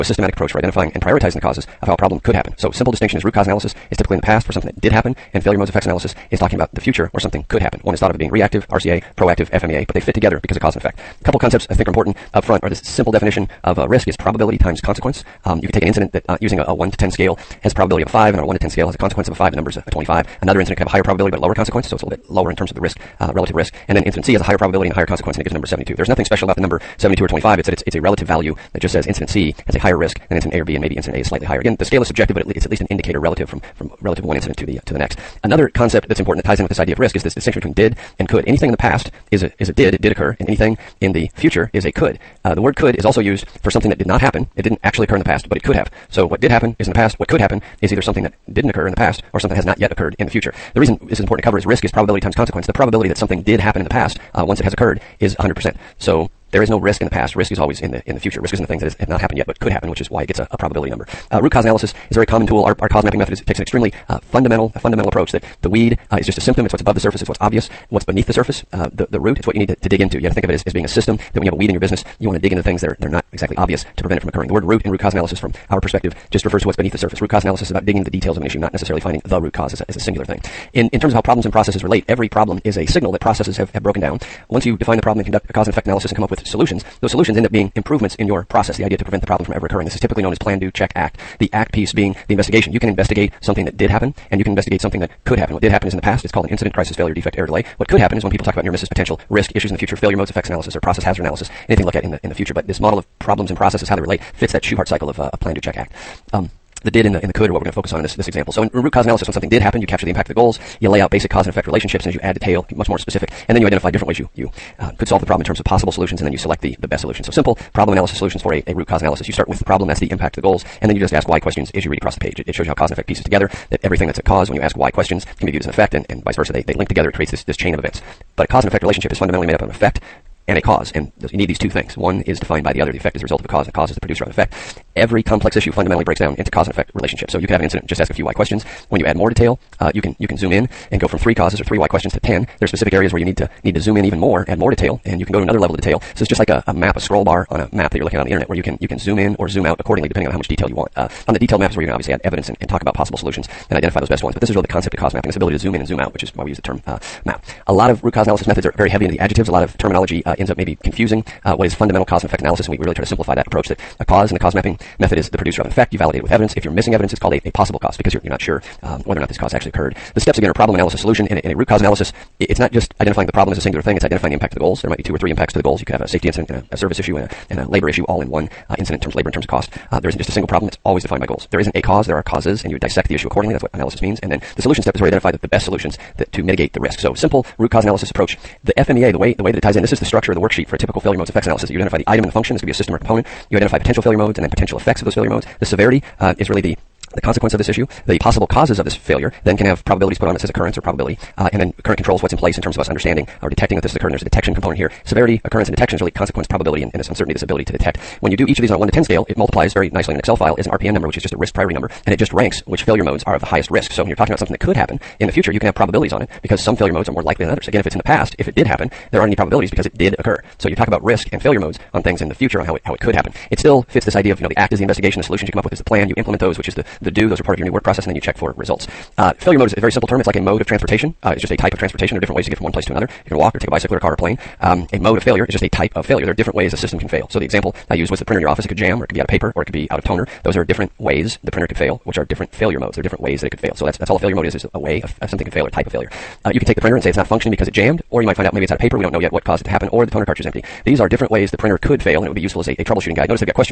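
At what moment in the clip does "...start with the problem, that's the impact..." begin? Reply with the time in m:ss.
1:59.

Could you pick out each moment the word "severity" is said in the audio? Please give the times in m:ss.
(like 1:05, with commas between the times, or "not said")
3:15, 3:25.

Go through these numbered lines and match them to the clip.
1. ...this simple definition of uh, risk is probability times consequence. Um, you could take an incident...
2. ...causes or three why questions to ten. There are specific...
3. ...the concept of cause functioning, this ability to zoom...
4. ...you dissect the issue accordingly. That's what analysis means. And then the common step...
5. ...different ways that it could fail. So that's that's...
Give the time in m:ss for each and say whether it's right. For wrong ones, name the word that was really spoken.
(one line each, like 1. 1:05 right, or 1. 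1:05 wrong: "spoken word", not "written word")
1. 0:12 right
2. 2:21 right
3. 2:34 wrong: "mapping", not "functioning"
4. 3:02 wrong: "solution", not "common"
5. 4:03 right.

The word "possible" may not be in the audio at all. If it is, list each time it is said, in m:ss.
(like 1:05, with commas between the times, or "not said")
1:55, 2:32, 2:47, 3:18.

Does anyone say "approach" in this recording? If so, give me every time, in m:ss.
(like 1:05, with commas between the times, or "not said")
0:00, 1:05, 2:43, 3:08.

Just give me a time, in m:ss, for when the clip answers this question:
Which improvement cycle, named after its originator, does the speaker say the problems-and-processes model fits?
1:44.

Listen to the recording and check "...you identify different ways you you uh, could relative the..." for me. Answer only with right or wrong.
wrong.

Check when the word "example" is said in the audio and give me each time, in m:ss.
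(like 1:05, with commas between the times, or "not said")
1:48, 3:57.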